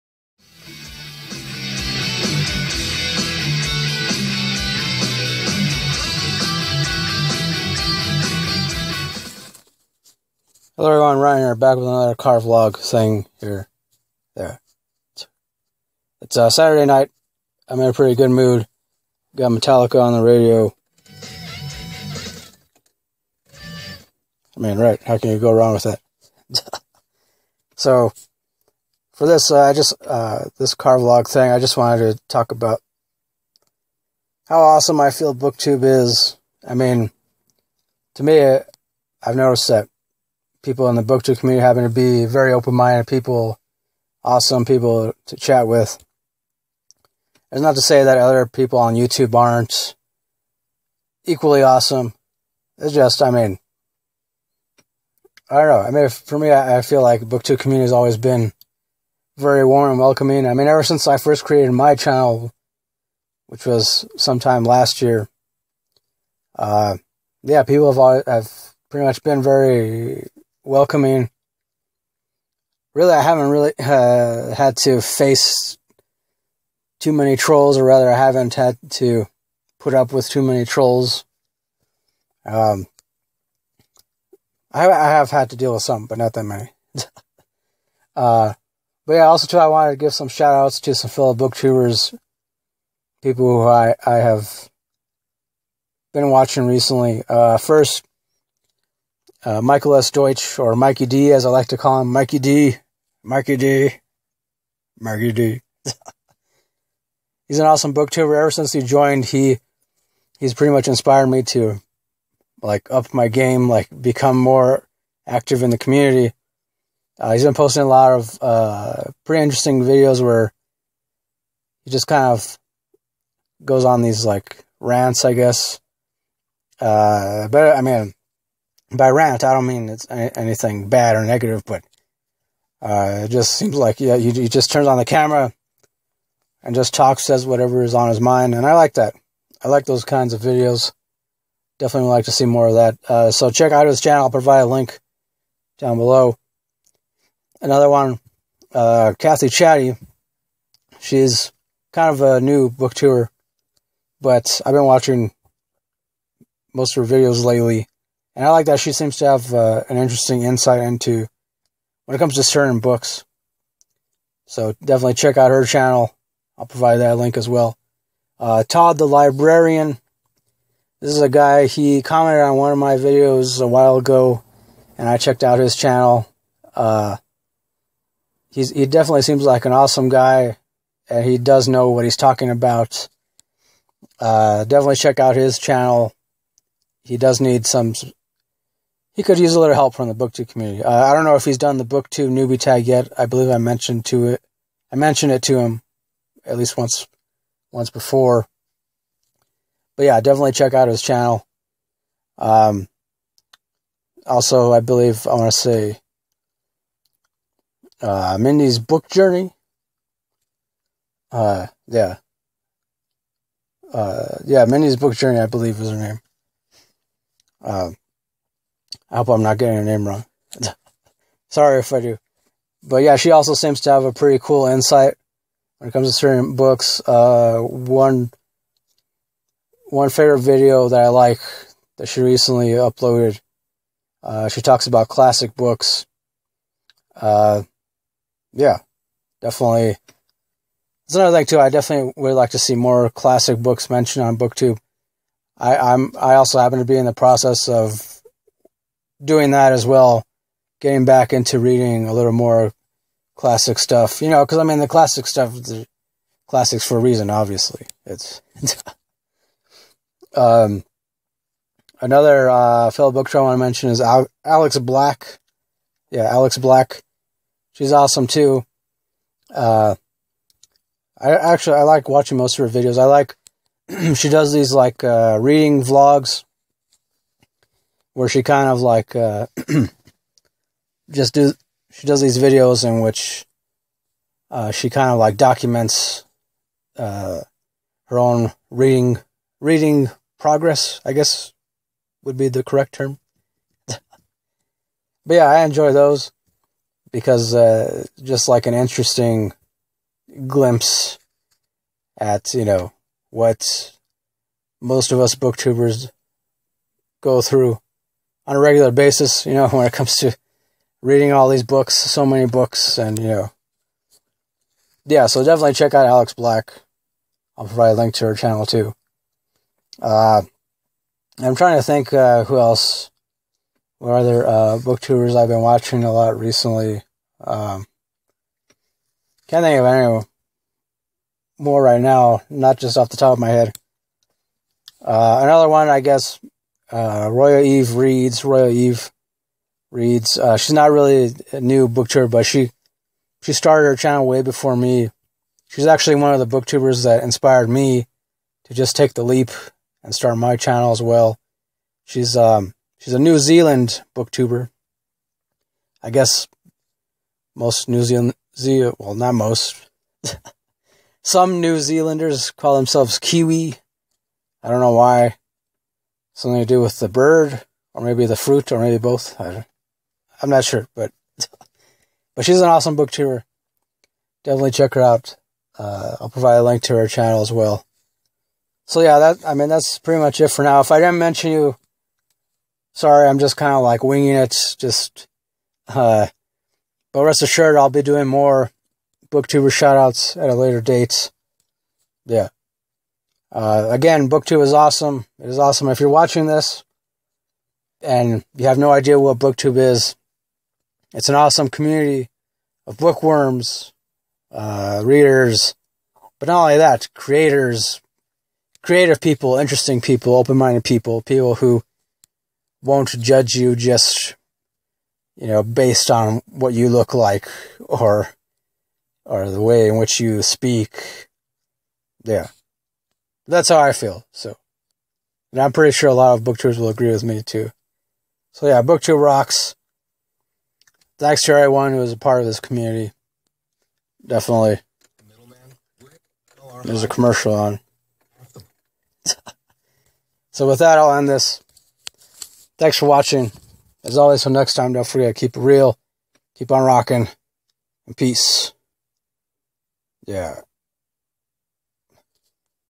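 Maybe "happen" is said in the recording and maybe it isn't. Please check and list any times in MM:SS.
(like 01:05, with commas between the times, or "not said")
00:41, 04:06.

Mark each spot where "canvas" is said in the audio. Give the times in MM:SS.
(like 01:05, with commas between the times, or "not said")
not said.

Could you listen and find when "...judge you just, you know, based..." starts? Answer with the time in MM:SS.
06:53.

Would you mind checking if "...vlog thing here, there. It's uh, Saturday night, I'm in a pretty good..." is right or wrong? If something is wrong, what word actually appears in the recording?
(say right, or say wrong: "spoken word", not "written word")
right.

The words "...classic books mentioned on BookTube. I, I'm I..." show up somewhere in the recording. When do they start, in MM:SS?
04:03.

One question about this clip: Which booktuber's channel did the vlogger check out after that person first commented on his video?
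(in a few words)
Todd the Librarian.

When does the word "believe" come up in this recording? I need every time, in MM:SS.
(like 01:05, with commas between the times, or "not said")
03:13, 03:24, 03:35.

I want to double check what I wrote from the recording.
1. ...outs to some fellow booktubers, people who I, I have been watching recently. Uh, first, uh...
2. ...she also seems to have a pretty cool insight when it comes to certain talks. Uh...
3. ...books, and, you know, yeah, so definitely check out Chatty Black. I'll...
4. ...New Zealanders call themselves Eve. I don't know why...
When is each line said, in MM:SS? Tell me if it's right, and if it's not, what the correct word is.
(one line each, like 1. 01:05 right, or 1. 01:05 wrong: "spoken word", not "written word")
1. 01:30 right
2. 03:43 wrong: "books", not "talks"
3. 05:12 wrong: "Alex", not "Chatty"
4. 06:01 wrong: "Kiwi", not "Eve".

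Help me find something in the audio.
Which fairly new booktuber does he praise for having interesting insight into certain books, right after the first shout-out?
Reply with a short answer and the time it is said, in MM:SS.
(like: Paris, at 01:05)
Kathy Chatty, at 02:29.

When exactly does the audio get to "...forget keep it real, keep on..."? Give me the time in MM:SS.
07:25.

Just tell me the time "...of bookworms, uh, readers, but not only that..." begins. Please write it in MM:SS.
06:42.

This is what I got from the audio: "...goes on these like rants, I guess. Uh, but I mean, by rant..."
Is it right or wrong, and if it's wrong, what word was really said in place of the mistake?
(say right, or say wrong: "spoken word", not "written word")
right.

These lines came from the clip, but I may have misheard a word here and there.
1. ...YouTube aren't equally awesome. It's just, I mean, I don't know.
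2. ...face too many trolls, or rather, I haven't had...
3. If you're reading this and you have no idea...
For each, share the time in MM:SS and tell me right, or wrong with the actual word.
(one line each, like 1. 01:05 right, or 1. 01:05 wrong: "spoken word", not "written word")
1. 00:48 right
2. 01:15 right
3. 06:35 wrong: "watching", not "reading".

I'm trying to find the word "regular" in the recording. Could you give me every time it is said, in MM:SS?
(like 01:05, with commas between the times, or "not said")
05:08.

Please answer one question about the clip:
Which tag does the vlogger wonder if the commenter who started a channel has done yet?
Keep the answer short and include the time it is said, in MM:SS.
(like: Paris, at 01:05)
BookTube newbie tag, at 03:11.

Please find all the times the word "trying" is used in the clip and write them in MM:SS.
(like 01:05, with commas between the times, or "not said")
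05:21.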